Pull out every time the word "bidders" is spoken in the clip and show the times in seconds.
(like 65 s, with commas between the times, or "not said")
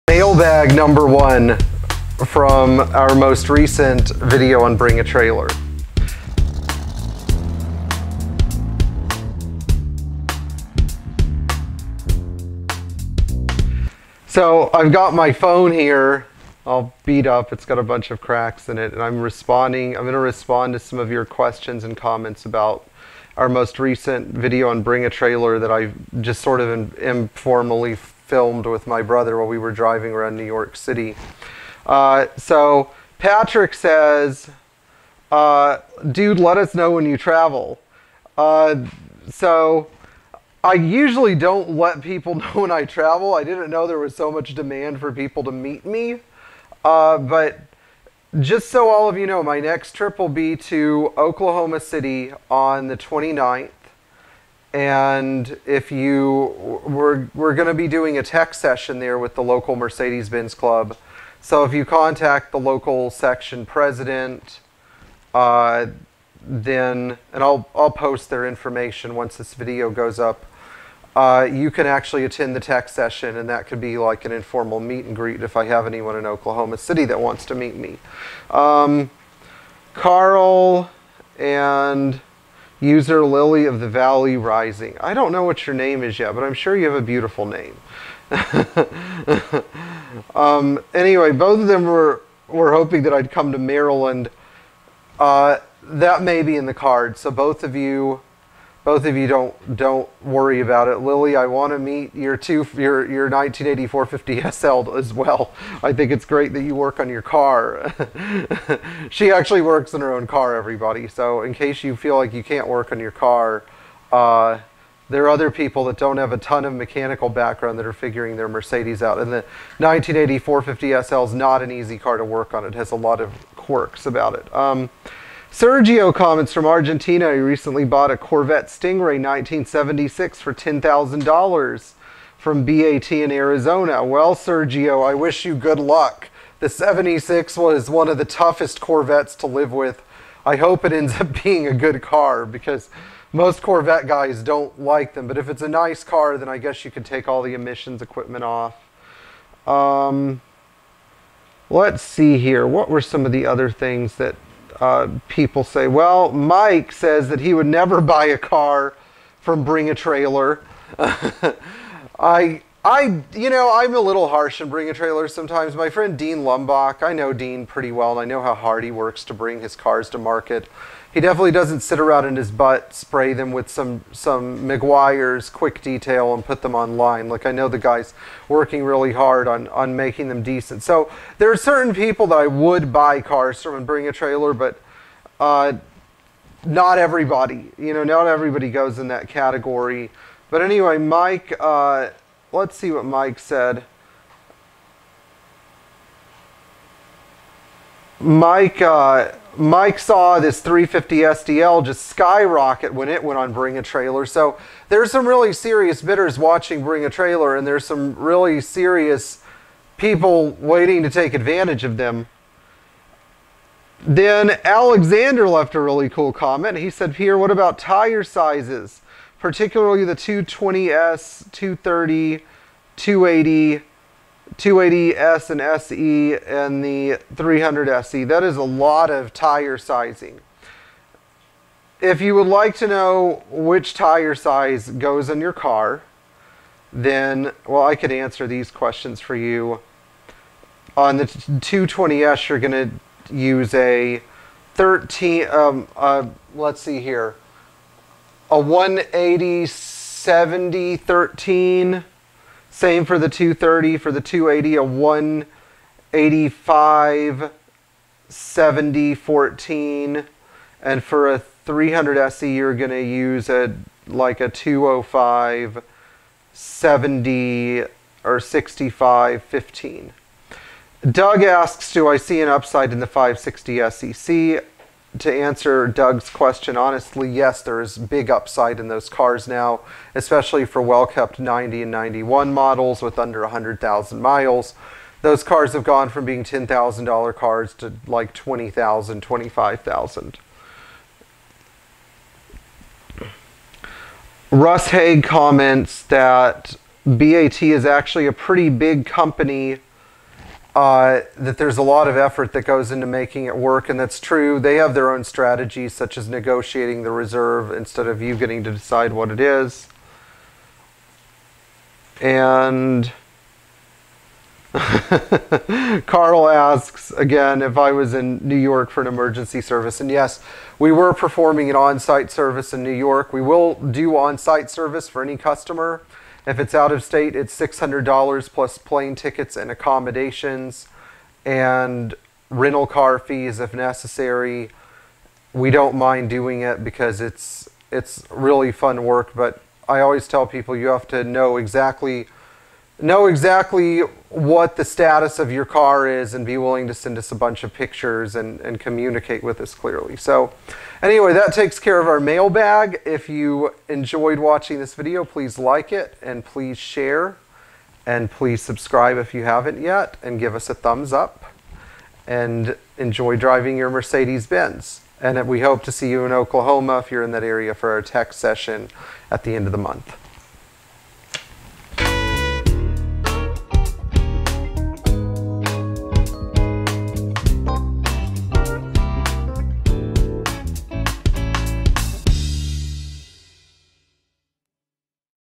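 206 s.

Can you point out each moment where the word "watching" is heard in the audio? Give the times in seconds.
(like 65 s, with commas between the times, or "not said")
206 s, 354 s.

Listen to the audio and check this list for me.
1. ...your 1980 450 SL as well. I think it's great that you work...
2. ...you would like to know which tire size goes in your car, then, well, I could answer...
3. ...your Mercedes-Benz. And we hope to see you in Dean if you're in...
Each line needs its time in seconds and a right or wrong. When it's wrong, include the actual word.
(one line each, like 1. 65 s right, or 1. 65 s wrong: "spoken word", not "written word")
1. 103 s right
2. 232 s right
3. 363 s wrong: "Oklahoma", not "Dean".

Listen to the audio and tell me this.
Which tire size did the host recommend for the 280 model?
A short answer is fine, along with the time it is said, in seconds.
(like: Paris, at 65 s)
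185/70/14, at 254 s.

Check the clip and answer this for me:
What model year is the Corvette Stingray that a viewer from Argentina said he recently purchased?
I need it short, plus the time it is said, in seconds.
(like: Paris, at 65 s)
1976, at 129 s.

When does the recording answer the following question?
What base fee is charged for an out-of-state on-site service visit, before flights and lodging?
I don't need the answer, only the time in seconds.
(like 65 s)
327 s.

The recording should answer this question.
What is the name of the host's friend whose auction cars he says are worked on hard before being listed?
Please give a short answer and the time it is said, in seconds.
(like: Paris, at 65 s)
Dean Lumbach, at 166 s.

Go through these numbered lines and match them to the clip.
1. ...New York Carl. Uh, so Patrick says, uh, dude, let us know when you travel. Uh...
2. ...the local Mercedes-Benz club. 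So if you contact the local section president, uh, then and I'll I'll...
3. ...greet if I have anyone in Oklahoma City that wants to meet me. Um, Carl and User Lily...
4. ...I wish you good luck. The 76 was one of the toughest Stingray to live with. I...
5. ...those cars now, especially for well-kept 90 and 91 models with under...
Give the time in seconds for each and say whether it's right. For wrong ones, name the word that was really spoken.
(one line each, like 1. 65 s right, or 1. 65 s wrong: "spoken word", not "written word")
1. 30 s wrong: "City", not "Carl"
2. 59 s right
3. 75 s right
4. 135 s wrong: "Corvettes", not "Stingray"
5. 278 s right.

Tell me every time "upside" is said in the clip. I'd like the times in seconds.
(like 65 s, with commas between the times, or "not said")
272 s, 278 s.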